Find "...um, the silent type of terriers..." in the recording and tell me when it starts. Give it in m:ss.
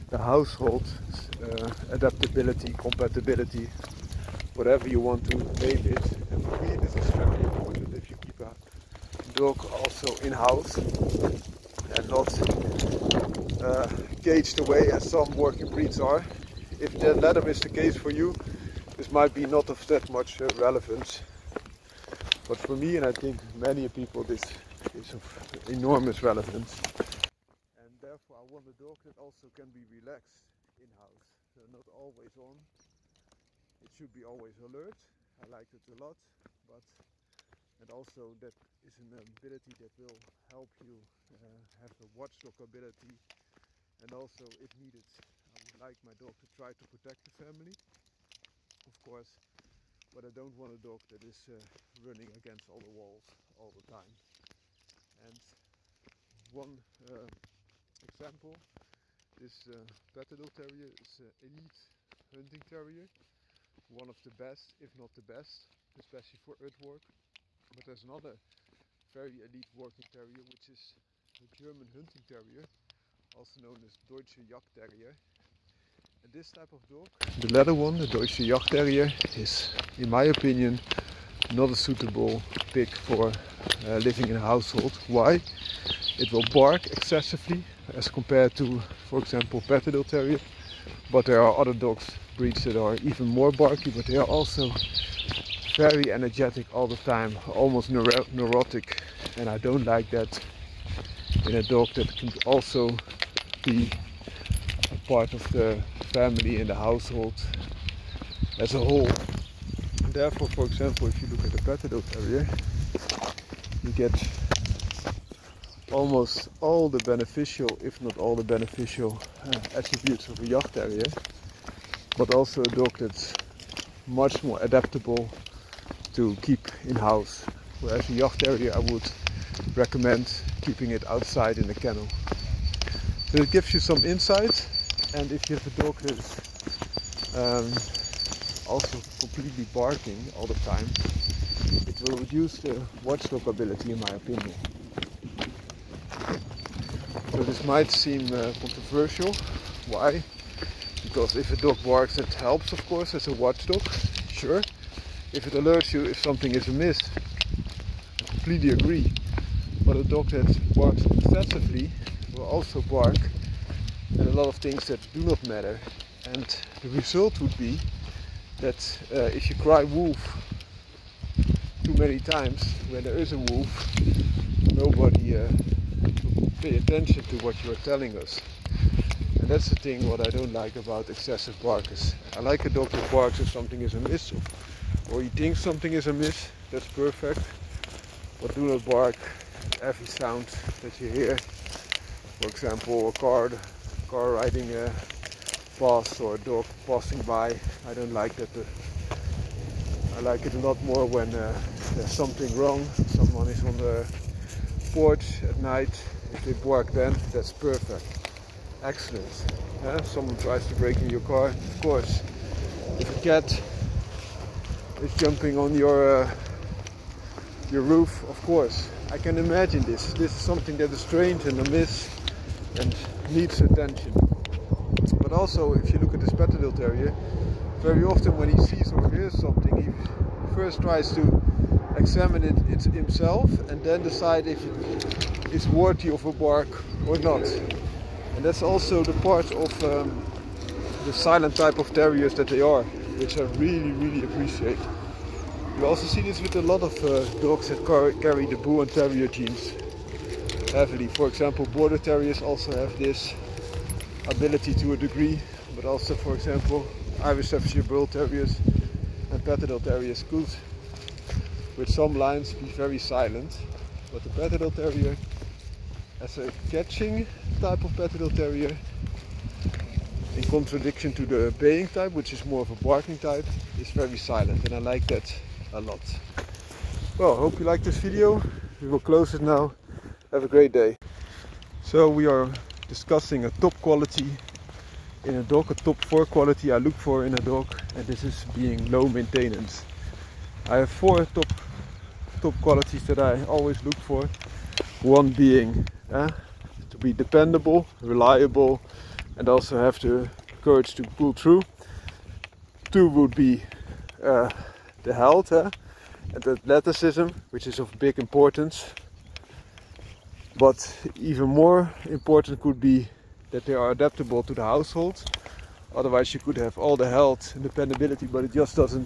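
3:59.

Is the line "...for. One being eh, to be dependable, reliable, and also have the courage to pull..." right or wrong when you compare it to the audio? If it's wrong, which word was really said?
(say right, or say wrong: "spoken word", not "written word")
right.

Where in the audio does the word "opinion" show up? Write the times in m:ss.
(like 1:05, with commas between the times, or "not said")
1:20, 2:24.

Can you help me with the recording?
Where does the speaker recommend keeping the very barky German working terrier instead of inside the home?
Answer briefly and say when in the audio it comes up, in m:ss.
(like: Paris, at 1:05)
in the kennel, at 2:11.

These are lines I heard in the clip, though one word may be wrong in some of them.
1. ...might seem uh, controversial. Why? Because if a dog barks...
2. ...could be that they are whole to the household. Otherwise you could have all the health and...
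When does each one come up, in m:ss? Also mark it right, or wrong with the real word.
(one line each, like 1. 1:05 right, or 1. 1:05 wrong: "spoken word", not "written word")
1. 2:27 right
2. 5:12 wrong: "adaptable", not "whole".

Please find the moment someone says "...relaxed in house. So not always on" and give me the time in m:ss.
0:29.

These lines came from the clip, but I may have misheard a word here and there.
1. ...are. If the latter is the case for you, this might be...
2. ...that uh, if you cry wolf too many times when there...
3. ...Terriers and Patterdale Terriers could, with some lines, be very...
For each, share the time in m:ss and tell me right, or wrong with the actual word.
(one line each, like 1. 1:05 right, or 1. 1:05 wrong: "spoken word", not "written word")
1. 0:15 right
2. 2:48 right
3. 4:18 right.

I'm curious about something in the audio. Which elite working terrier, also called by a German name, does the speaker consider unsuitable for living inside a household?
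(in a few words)
German hunting terrier.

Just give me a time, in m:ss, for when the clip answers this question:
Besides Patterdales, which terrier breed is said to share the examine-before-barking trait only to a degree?
4:11.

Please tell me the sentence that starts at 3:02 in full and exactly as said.
I like a dog that barks if something is amiss or he thinks something is amiss, that's perfect.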